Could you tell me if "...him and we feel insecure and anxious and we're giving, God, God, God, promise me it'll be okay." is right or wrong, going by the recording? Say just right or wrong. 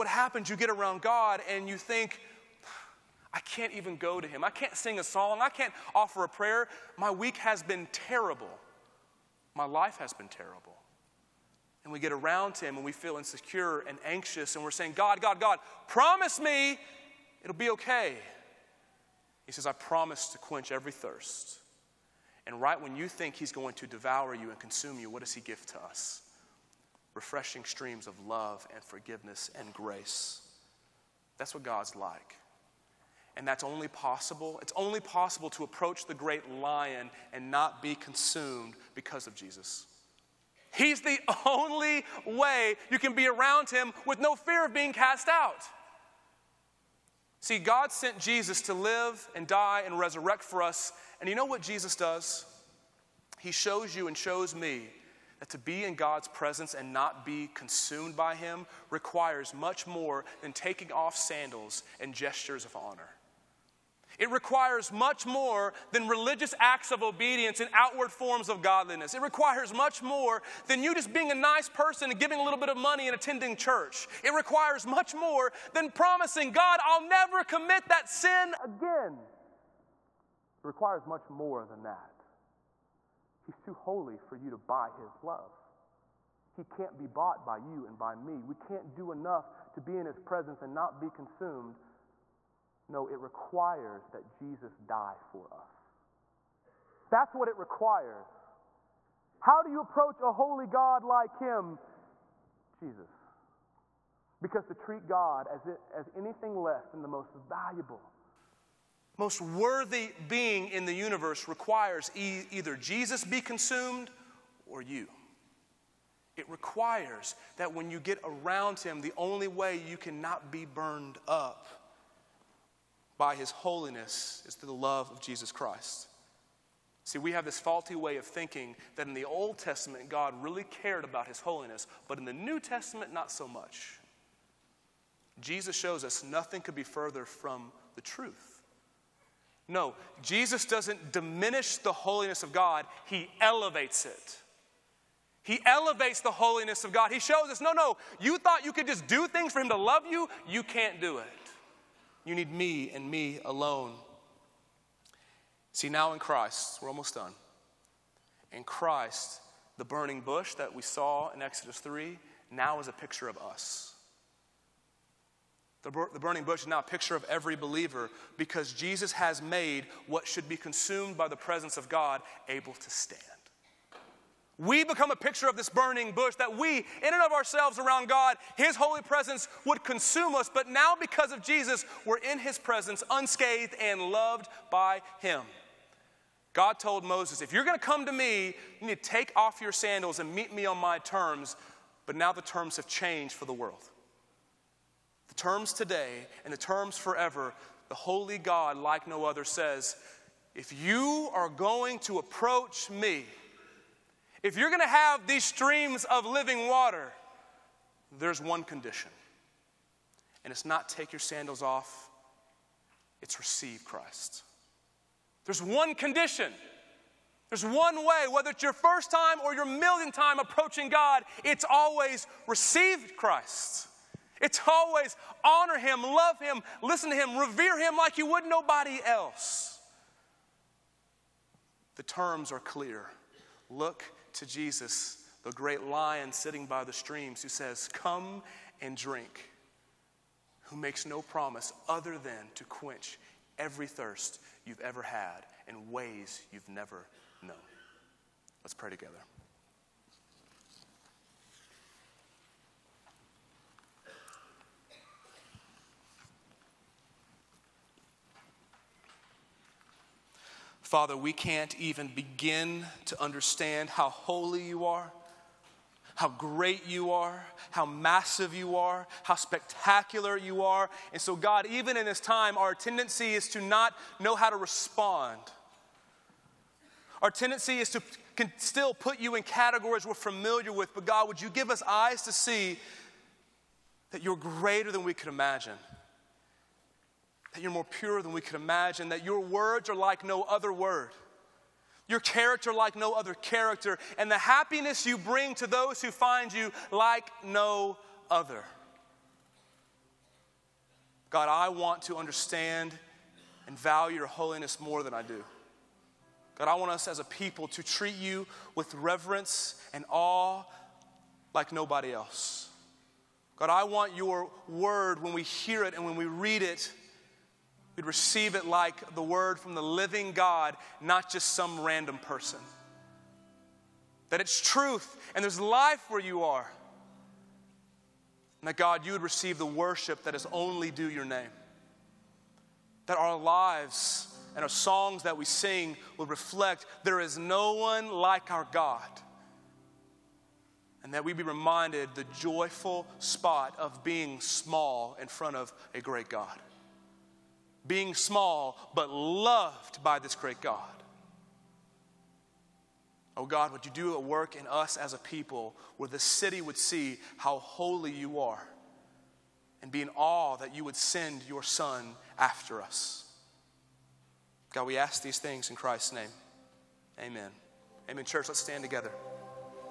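wrong.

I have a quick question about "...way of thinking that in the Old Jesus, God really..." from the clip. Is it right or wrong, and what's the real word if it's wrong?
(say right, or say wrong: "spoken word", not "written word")
wrong: "Testament", not "Jesus".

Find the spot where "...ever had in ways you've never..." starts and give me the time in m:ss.
4:04.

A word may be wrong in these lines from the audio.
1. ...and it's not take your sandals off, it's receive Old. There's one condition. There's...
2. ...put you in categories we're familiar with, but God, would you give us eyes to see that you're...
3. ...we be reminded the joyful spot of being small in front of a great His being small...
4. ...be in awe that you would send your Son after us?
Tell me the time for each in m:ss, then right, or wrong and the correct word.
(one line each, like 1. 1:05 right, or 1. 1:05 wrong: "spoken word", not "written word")
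1. 3:30 wrong: "Christ", not "Old"
2. 4:38 right
3. 5:41 wrong: "God", not "His"
4. 5:59 right.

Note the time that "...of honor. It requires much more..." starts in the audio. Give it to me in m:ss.
1:02.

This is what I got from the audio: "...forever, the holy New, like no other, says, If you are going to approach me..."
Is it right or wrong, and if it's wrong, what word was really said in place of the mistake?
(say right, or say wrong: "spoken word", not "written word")
wrong: "God", not "New".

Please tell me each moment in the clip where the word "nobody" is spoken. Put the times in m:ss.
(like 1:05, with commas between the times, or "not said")
3:48, 5:11.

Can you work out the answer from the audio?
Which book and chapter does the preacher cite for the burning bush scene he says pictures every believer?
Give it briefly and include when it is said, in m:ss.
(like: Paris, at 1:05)
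Exodus 3, at 2:41.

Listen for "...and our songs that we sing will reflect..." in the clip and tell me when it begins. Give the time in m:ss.
5:34.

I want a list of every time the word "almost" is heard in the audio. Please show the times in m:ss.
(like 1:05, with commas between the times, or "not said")
2:36.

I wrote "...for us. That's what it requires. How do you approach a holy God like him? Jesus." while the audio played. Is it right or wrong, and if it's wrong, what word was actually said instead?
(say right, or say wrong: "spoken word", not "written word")
right.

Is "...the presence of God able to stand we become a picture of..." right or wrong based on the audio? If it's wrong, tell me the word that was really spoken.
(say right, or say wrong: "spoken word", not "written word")
right.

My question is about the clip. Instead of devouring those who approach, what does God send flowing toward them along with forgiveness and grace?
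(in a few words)
Refreshing streams of love.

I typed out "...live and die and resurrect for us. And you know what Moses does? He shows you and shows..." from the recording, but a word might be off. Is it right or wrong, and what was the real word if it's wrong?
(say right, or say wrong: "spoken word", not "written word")
wrong: "Jesus", not "Moses".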